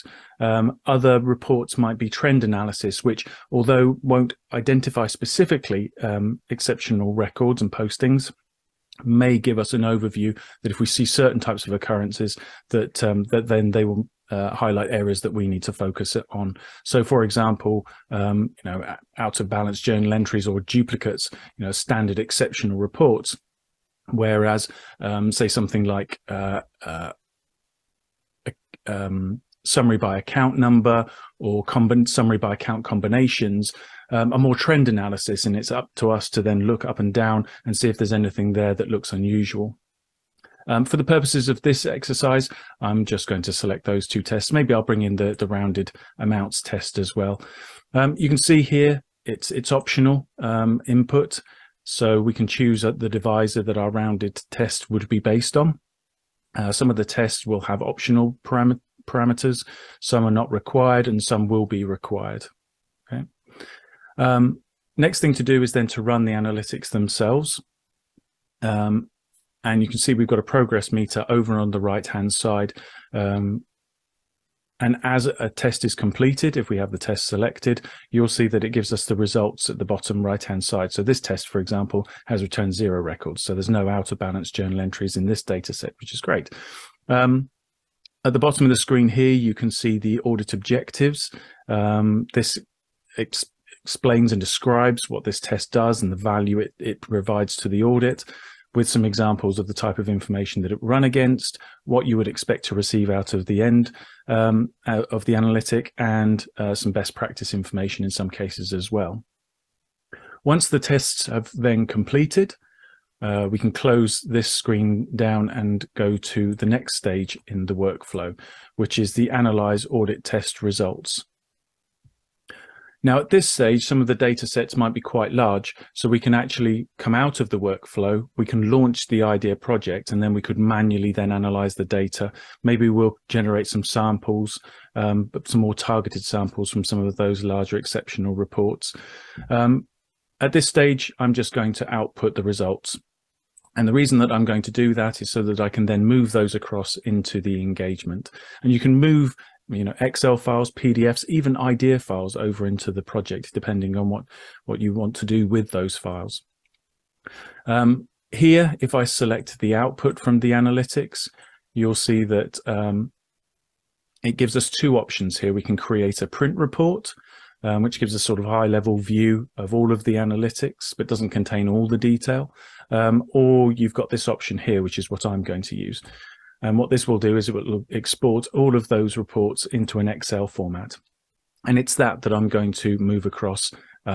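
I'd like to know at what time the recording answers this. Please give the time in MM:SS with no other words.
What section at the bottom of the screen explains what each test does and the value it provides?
01:30.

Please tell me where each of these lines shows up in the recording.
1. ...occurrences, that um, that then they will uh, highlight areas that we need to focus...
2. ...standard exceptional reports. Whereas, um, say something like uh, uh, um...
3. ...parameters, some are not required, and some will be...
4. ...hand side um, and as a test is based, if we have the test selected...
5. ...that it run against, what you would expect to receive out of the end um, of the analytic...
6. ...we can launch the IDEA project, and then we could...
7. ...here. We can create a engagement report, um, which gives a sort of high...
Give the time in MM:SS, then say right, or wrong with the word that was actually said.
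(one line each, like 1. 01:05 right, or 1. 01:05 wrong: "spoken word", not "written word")
1. 00:11 right
2. 00:21 right
3. 00:59 right
4. 01:12 wrong: "completed", not "based"
5. 01:40 right
6. 02:08 right
7. 02:45 wrong: "print", not "engagement".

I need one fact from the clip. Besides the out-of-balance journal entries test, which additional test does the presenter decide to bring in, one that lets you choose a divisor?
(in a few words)
Rounded amounts test.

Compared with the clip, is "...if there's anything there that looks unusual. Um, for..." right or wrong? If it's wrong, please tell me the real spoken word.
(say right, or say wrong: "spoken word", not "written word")
right.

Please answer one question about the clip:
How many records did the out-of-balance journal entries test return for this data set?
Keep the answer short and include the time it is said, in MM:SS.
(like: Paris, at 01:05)
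0, at 01:22.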